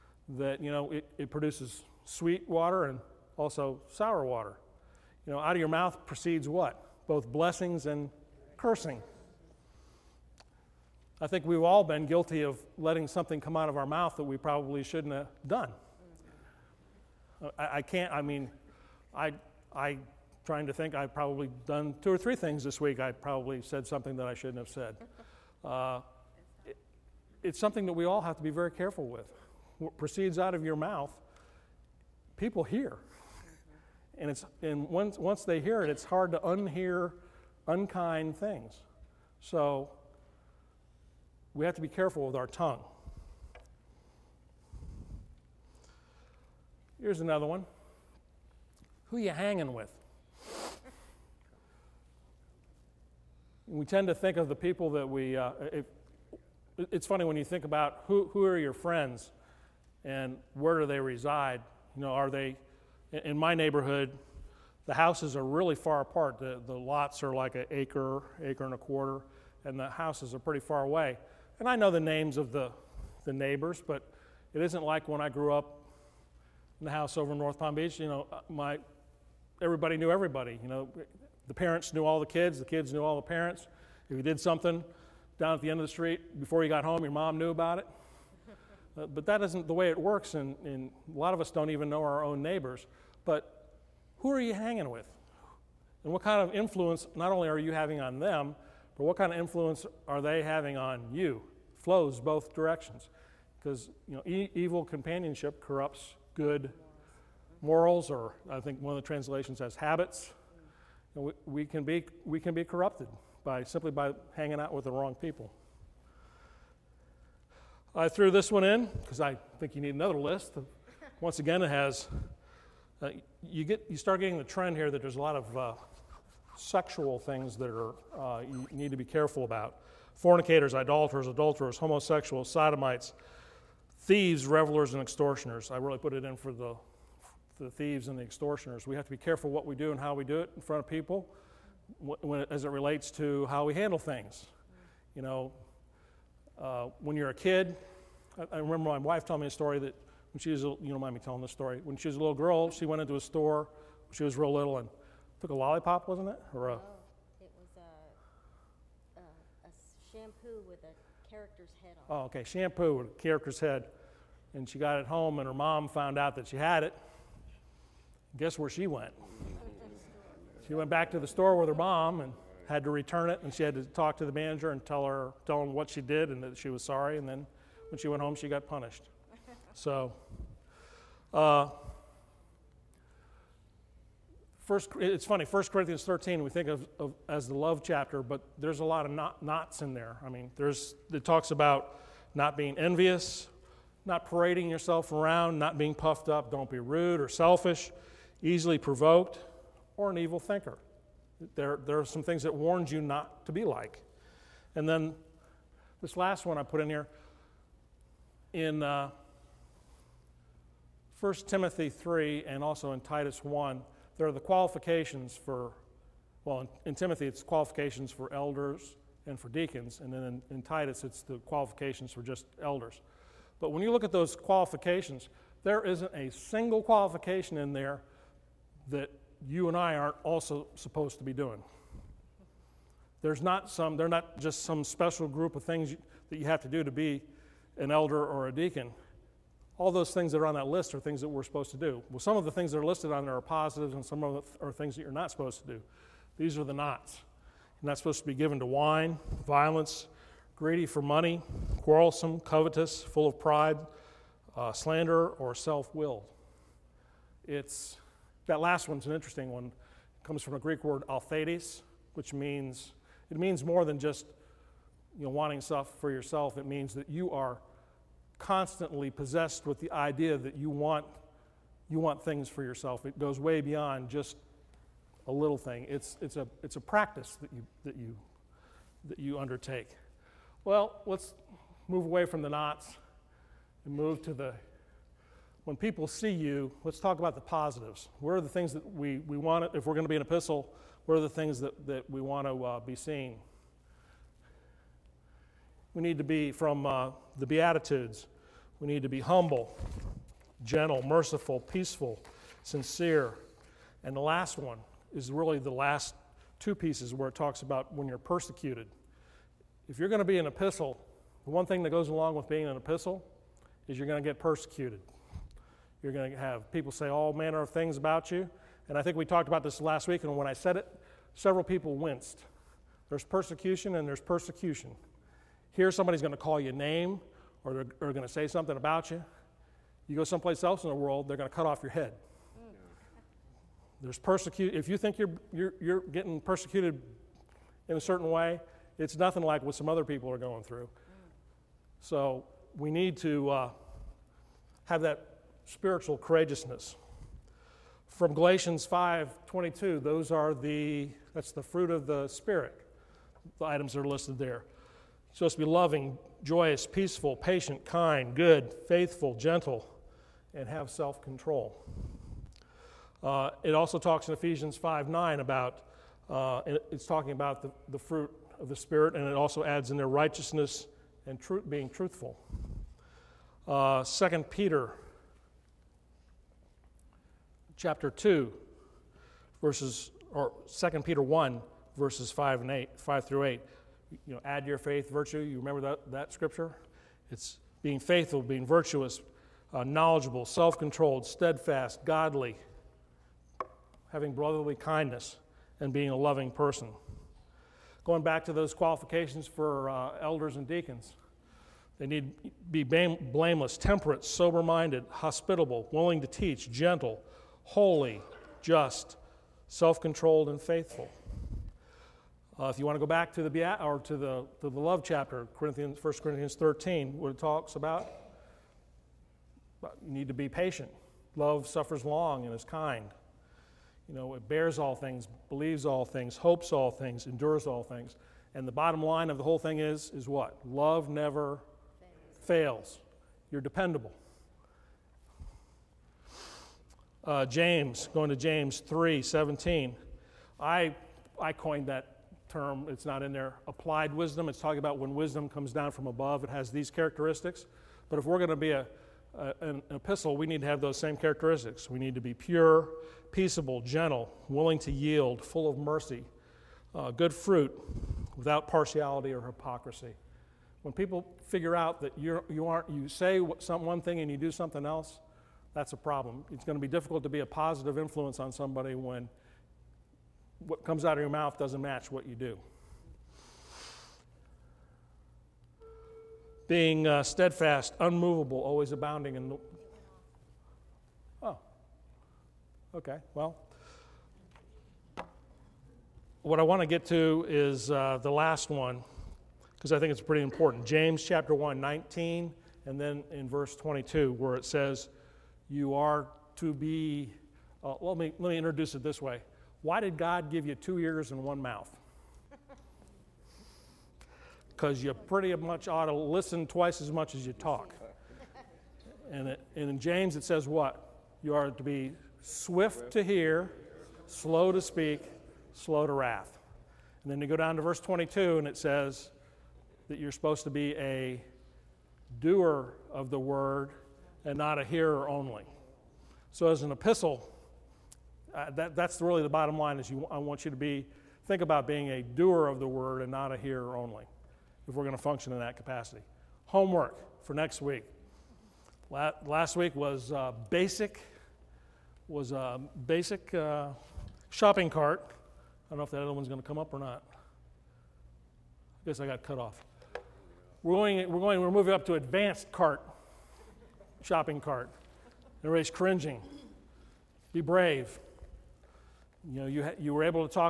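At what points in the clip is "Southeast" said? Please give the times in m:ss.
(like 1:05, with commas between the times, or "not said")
not said.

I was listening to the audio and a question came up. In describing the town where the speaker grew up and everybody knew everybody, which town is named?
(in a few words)
North Palm Beach.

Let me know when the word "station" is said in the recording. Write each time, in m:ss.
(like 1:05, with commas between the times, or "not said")
not said.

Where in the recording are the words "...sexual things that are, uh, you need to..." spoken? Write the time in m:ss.
2:06.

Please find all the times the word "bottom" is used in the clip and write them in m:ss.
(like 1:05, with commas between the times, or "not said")
7:08, 8:49.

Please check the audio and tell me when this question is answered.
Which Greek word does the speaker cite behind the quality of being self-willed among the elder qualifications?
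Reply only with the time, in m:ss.
4:21.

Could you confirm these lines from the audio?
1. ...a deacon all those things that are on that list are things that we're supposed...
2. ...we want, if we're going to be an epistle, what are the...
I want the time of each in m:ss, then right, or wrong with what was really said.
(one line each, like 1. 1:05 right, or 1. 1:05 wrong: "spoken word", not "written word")
1. 3:58 right
2. 4:49 right.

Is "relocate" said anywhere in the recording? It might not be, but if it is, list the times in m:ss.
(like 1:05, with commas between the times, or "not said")
not said.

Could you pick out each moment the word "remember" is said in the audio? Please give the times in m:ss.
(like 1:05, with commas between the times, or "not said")
2:28, 6:25.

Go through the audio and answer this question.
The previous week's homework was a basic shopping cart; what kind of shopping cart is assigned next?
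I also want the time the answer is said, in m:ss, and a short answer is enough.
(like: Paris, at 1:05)
Advanced cart, at 9:12.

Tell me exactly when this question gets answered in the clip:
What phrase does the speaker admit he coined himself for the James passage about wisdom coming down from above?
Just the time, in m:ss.
7:23.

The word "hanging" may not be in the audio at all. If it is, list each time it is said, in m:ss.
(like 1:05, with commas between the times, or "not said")
0:49, 1:34, 1:54.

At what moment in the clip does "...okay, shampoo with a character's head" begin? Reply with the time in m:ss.
2:42.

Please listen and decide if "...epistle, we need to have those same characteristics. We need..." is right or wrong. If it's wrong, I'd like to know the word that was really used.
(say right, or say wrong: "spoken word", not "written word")
right.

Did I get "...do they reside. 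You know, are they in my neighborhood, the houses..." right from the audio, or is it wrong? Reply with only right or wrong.
right.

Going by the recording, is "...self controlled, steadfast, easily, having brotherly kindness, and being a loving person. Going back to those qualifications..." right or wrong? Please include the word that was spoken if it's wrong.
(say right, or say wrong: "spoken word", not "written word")
wrong: "godly", not "easily".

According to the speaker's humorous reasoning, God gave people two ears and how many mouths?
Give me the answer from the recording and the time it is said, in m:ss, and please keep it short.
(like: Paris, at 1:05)
1, at 8:21.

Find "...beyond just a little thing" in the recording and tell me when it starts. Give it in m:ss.
4:33.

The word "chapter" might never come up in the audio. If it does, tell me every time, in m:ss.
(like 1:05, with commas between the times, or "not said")
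3:07, 6:17, 6:55, 8:11.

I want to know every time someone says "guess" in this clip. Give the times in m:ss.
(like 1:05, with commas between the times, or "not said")
2:48, 9:09.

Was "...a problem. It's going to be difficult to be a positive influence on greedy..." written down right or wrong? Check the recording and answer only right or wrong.
wrong.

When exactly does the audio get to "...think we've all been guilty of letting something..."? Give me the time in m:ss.
0:11.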